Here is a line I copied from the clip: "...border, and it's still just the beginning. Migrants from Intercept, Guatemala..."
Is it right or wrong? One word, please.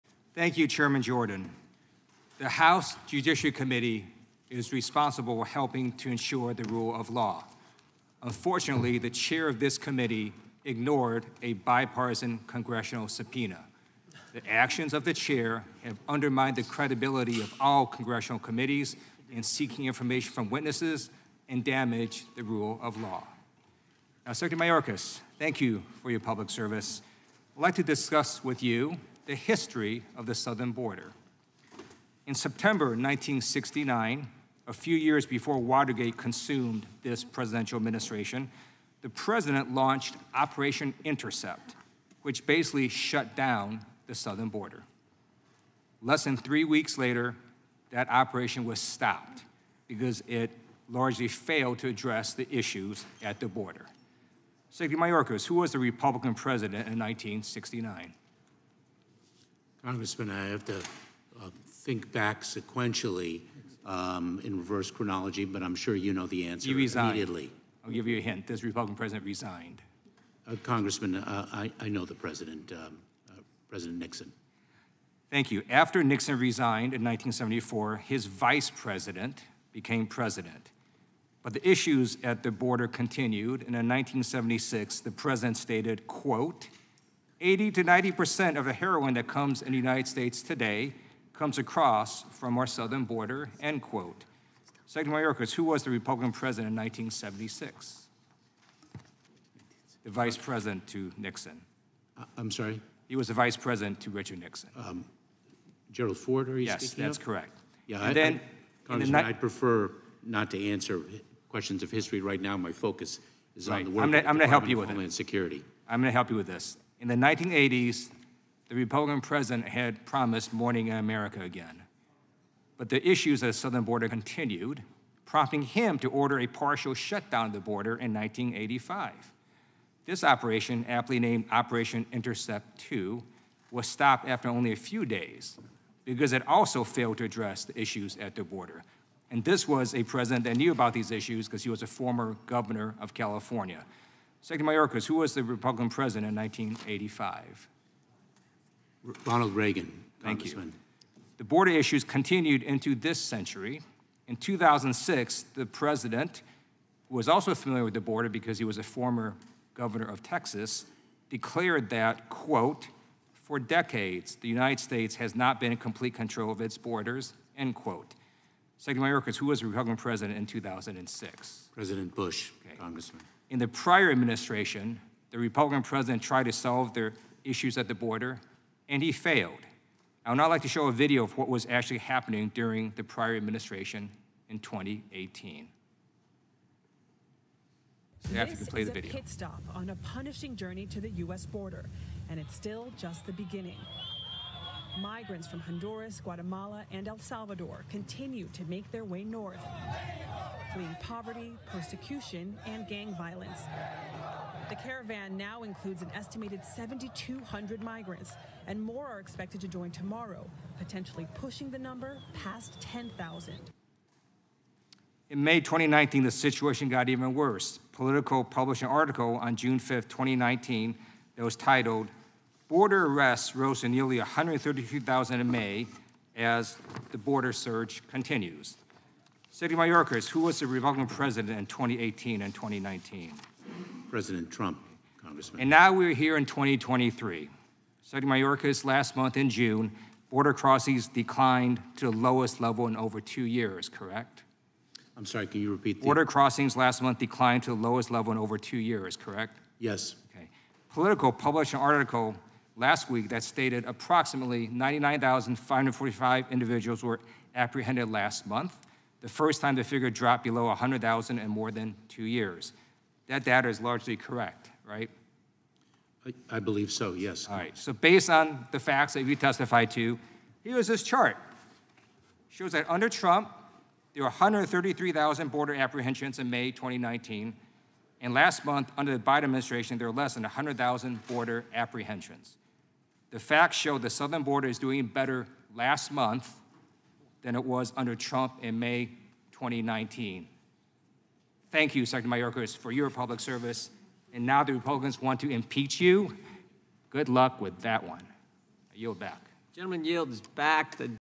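wrong.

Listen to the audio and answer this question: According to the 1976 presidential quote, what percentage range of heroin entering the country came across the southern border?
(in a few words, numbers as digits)
80 to 90%.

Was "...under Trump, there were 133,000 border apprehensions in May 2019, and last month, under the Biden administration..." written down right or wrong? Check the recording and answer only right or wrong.
right.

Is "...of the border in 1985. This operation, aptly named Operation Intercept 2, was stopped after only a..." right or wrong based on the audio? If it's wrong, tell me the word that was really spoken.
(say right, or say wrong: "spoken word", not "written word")
right.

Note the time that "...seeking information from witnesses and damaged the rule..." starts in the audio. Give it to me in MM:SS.
00:19.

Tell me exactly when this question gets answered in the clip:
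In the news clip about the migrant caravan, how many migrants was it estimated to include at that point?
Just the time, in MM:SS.
03:26.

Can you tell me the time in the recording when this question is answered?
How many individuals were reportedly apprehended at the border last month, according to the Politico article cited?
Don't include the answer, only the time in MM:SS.
04:14.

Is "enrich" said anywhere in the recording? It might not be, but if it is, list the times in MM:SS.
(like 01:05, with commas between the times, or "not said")
not said.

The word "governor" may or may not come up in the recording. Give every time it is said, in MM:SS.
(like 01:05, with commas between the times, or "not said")
02:22, 02:39.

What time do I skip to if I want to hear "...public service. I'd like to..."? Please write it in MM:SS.
00:26.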